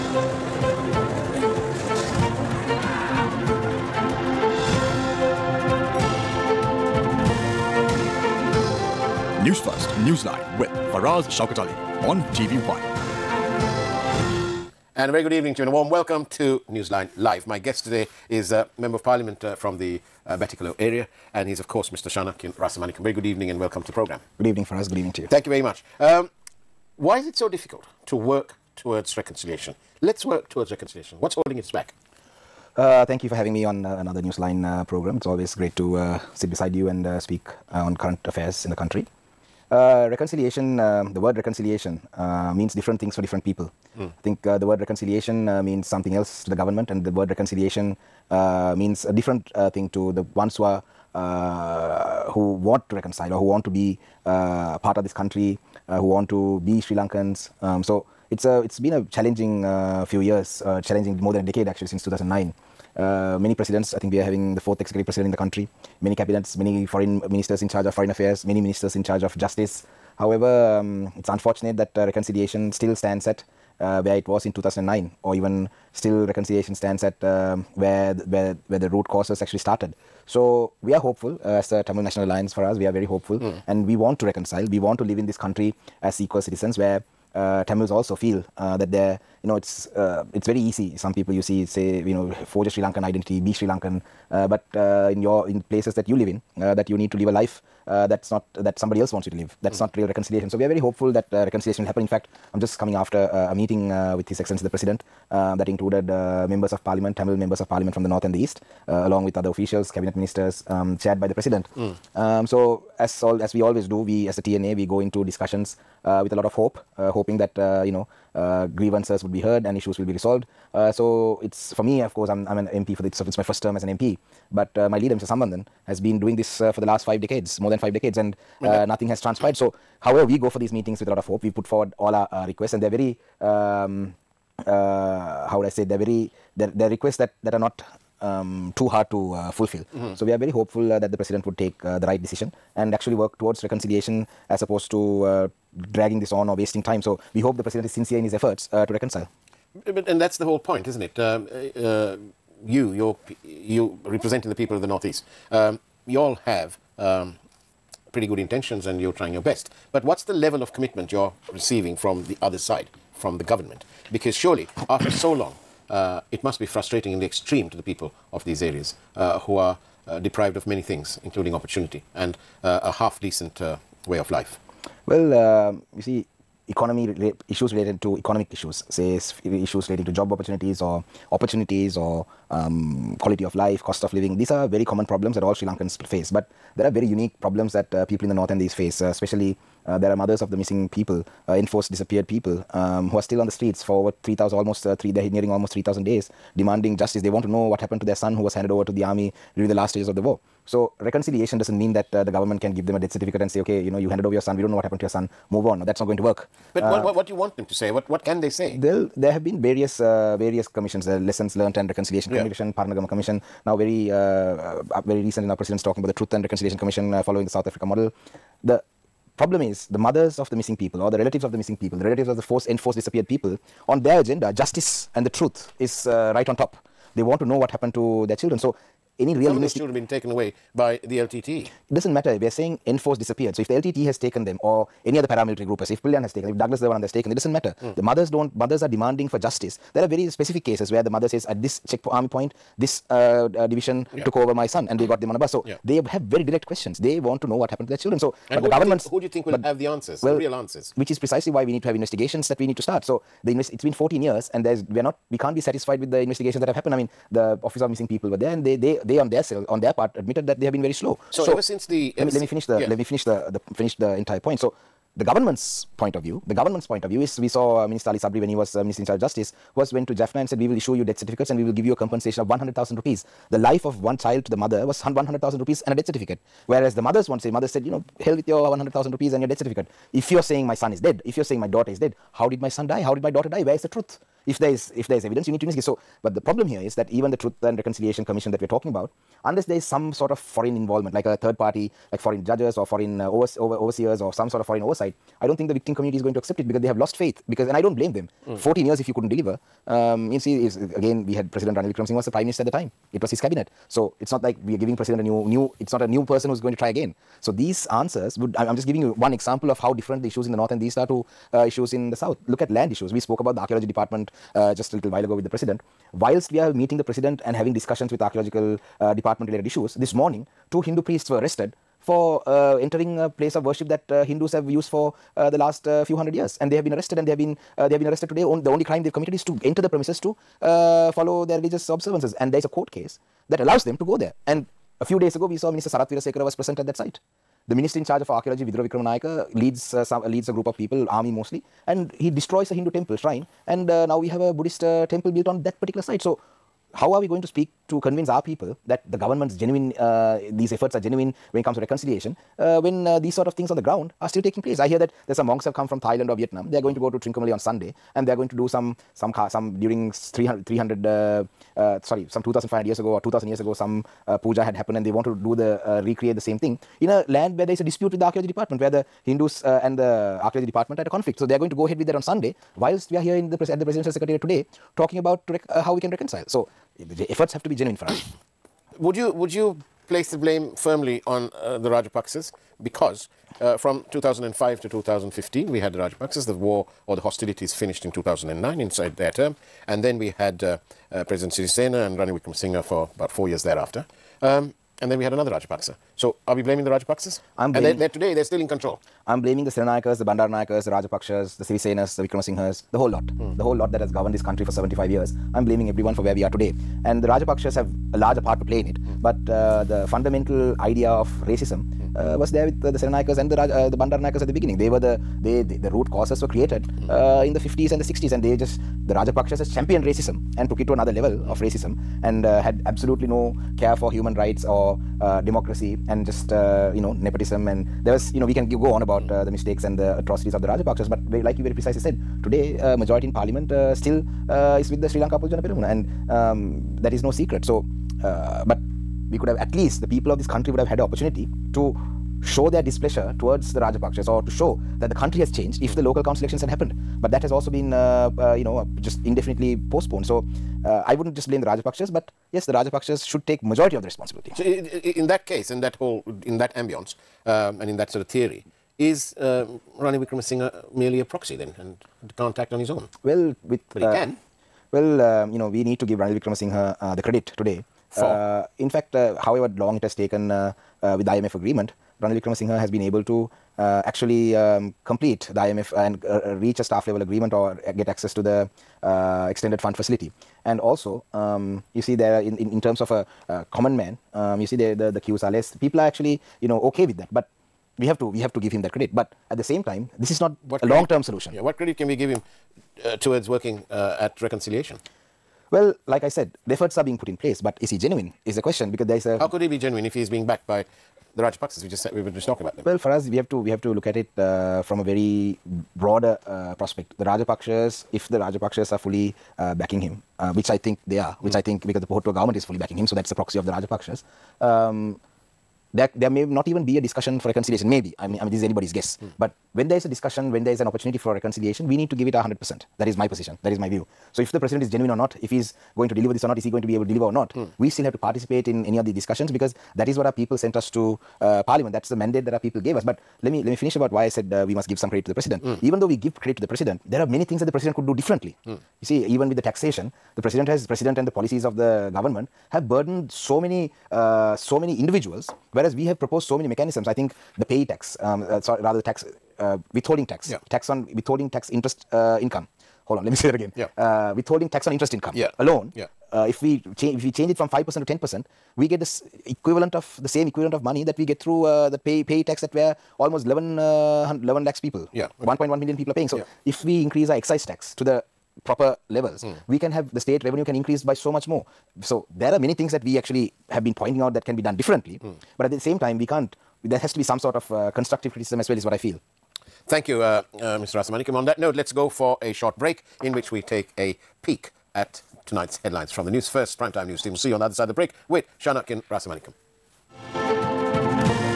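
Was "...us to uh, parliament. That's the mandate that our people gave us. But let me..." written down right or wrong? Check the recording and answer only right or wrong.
right.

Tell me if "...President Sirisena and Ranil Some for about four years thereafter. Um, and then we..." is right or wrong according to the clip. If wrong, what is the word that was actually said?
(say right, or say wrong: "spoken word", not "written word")
wrong: "Wickremesinghe", not "Some".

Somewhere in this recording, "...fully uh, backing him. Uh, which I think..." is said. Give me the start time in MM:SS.
08:28.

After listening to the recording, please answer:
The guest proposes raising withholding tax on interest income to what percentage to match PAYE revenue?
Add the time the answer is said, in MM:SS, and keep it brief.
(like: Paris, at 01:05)
10%, at 09:18.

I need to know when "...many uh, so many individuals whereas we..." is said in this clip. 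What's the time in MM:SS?
09:03.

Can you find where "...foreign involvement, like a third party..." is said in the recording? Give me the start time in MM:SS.
04:50.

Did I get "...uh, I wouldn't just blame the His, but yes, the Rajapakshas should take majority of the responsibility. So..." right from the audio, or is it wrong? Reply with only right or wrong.
wrong.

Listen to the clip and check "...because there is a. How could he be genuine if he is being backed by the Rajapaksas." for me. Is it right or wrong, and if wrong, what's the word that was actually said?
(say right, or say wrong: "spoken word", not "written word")
right.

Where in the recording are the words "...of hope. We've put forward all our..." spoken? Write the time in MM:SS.
02:11.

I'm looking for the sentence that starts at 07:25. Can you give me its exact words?
the local council elections had happened.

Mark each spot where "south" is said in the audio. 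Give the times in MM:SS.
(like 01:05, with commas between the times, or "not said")
03:37, 05:12.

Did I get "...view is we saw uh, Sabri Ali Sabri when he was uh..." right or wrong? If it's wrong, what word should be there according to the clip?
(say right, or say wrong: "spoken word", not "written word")
wrong: "Minister", not "Sabri".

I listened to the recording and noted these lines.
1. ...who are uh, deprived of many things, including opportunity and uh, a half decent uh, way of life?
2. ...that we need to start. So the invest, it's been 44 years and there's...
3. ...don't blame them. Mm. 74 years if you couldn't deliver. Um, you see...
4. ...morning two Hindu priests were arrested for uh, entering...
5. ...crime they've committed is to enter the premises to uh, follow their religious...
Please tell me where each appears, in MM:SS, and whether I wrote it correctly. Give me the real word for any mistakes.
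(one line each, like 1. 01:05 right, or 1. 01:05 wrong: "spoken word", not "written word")
1. 02:49 right
2. 04:12 wrong: "14", not "44"
3. 04:57 wrong: "14", not "74"
4. 05:20 right
5. 05:28 right.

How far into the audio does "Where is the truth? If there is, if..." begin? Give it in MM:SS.
04:43.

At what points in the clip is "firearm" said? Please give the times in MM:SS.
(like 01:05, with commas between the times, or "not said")
not said.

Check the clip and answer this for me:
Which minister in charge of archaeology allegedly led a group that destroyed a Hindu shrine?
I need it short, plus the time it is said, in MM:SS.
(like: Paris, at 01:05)
Vidura Wickramanayaka, at 05:38.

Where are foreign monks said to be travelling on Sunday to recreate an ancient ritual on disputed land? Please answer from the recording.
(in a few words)
Trincomalee.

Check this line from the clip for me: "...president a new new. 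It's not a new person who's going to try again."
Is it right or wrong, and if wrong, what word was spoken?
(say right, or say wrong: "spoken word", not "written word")
right.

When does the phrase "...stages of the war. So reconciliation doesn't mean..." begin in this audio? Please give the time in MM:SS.
03:19.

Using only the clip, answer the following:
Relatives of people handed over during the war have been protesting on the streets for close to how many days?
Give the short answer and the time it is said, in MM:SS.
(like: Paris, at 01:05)
3,000, at 03:15.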